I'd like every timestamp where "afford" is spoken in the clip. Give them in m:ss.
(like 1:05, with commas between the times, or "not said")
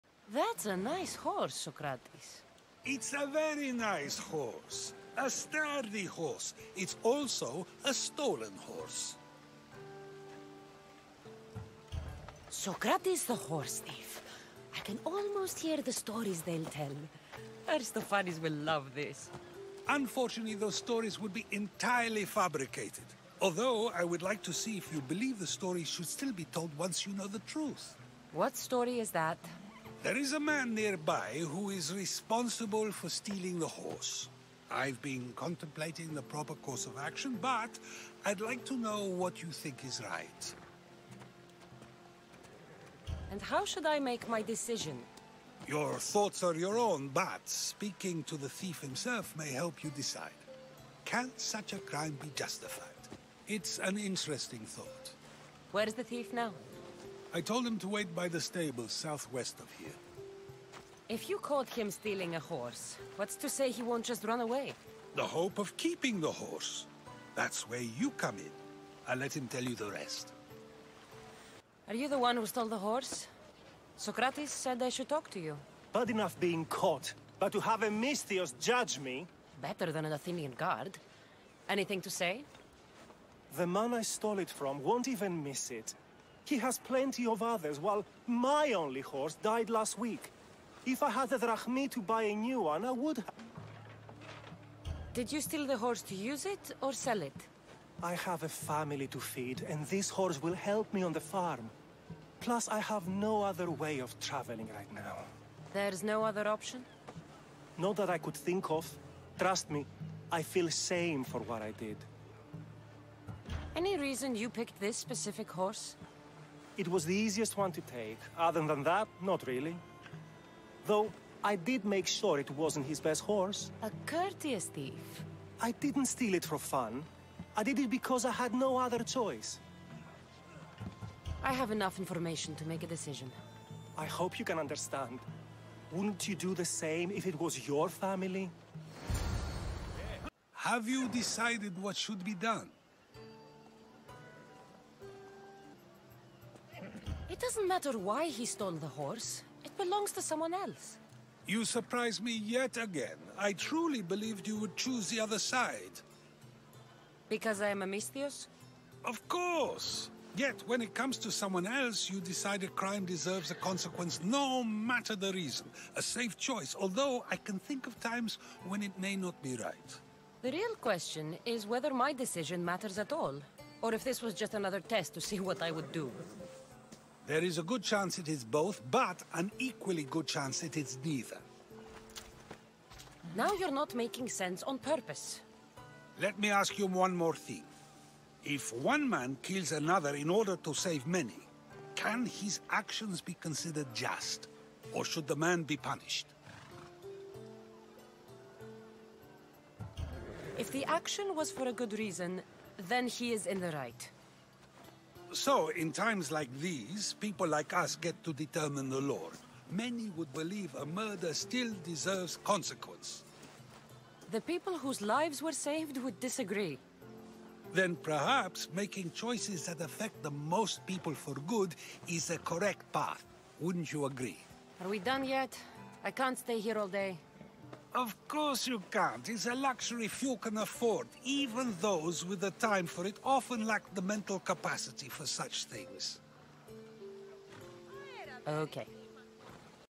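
3:50.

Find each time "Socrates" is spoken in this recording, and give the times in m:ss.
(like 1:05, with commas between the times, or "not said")
0:01, 0:12, 1:13.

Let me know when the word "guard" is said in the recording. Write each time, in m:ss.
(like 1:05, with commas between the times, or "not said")
1:20.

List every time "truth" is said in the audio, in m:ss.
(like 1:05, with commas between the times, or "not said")
0:27.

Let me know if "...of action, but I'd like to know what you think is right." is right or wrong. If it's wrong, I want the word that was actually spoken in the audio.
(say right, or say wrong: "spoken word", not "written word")
right.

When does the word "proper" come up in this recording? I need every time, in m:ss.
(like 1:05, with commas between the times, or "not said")
0:36.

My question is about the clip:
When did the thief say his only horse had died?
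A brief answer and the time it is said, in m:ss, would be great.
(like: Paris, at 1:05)
last week, at 1:29.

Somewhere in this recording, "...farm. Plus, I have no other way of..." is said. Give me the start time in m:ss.
1:41.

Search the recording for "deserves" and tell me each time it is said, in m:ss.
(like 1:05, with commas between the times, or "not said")
2:43, 3:31.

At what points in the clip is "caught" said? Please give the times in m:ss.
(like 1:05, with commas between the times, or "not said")
1:01, 1:16.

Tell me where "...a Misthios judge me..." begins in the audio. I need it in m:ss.
1:17.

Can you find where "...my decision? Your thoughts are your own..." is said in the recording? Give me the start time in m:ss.
0:44.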